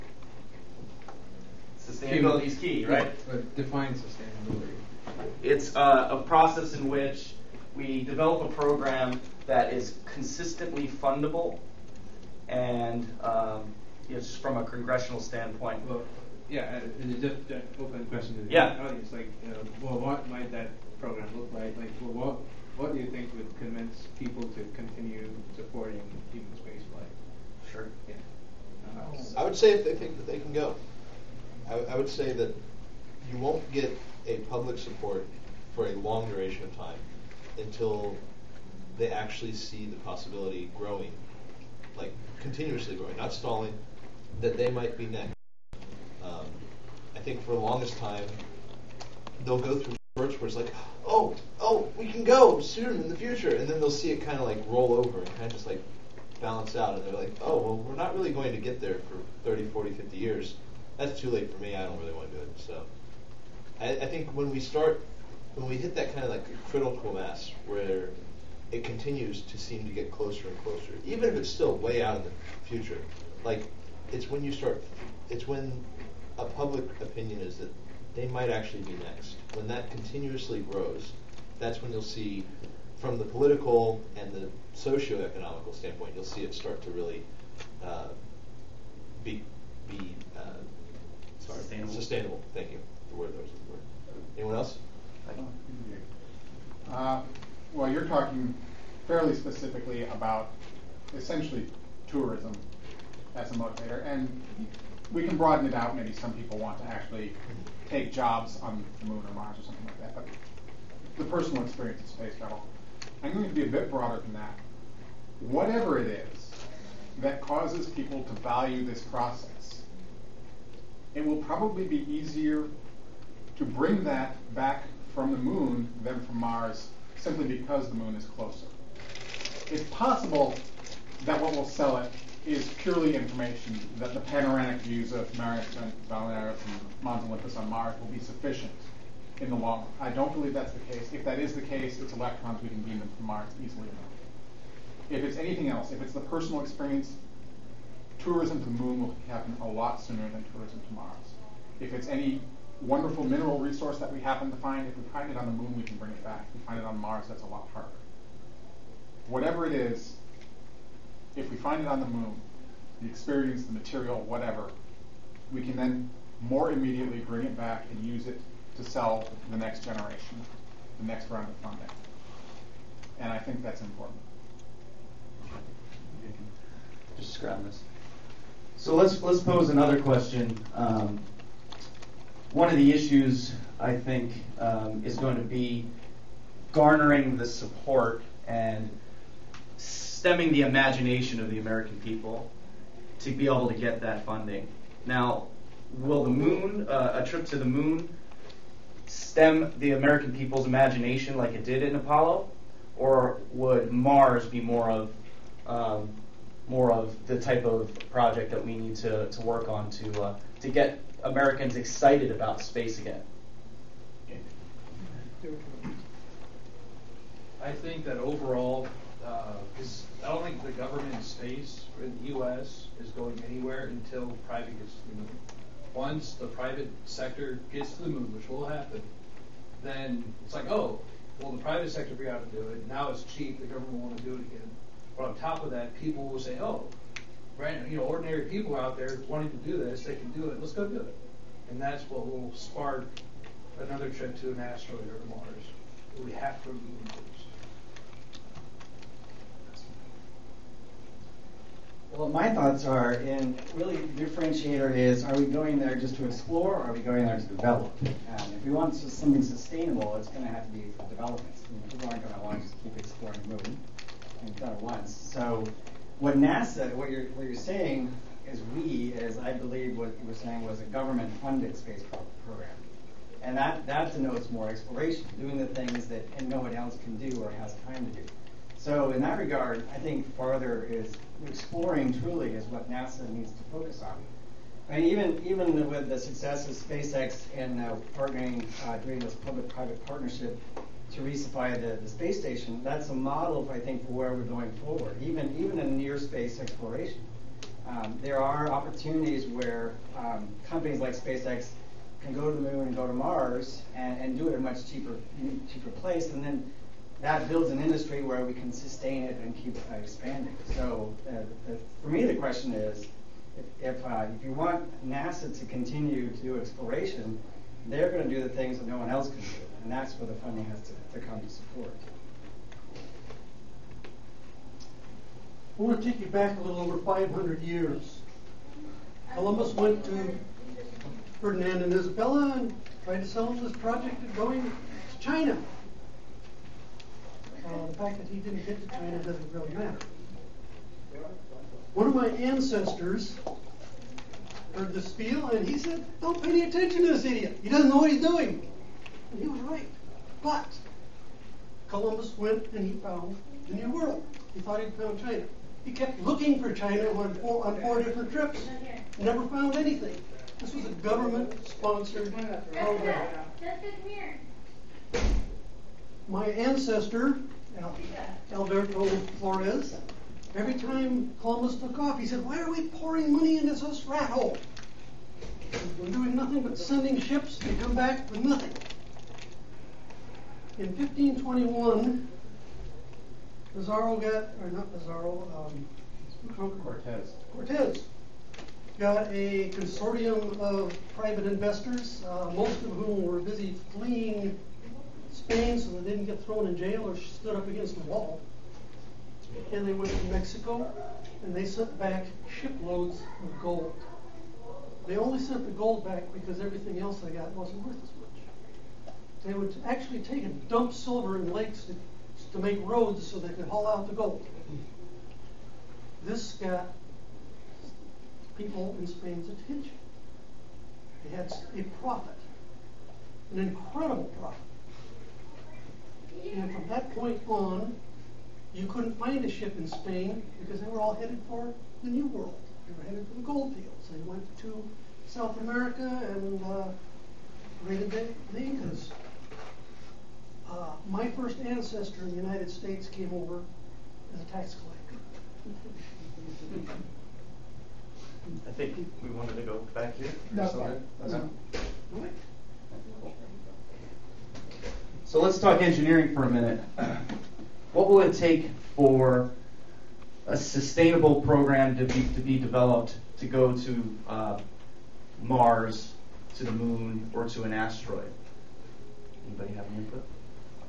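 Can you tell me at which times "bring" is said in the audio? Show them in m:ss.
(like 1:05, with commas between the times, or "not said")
2:03, 2:35, 2:47.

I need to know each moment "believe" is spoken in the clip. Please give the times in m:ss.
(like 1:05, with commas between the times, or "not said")
2:20, 4:29.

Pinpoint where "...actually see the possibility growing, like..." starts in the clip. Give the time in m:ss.
0:39.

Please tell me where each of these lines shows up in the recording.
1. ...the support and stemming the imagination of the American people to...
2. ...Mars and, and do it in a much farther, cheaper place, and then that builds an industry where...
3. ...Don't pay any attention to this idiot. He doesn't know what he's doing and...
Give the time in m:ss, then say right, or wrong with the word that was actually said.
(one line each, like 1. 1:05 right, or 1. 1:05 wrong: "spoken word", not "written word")
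1. 3:07 right
2. 5:03 wrong: "cheaper", not "farther"
3. 5:46 right.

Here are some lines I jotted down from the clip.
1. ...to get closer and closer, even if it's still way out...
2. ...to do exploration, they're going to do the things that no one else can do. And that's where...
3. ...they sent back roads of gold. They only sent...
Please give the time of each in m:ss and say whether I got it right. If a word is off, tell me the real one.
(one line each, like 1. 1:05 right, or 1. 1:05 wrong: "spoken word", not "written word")
1. 1:09 right
2. 5:16 right
3. 6:41 wrong: "shiploads", not "roads".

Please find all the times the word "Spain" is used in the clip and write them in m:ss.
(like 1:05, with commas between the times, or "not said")
6:35, 6:59, 7:09.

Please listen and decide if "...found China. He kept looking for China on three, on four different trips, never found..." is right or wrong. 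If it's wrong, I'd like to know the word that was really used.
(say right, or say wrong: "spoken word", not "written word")
wrong: "four", not "three".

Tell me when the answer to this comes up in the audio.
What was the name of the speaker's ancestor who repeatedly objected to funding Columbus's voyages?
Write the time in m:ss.
6:08.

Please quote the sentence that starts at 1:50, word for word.
But the personal experience of space travel.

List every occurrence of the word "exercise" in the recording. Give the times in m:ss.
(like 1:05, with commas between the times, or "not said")
not said.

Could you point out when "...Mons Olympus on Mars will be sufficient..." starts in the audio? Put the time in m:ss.
2:17.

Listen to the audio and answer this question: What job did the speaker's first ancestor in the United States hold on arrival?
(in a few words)
Tax collector.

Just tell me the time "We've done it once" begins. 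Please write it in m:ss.
4:24.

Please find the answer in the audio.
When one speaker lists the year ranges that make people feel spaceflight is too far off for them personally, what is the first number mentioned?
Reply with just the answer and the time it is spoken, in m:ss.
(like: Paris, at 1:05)
30, at 0:59.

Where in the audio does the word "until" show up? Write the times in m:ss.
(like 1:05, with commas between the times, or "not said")
0:37, 3:43.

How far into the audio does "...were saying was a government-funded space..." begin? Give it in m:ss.
4:30.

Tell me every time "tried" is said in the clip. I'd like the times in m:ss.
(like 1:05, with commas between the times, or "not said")
5:33.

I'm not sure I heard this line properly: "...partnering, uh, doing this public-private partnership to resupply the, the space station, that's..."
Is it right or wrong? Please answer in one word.
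right.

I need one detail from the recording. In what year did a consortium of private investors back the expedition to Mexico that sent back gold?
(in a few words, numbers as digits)
1521.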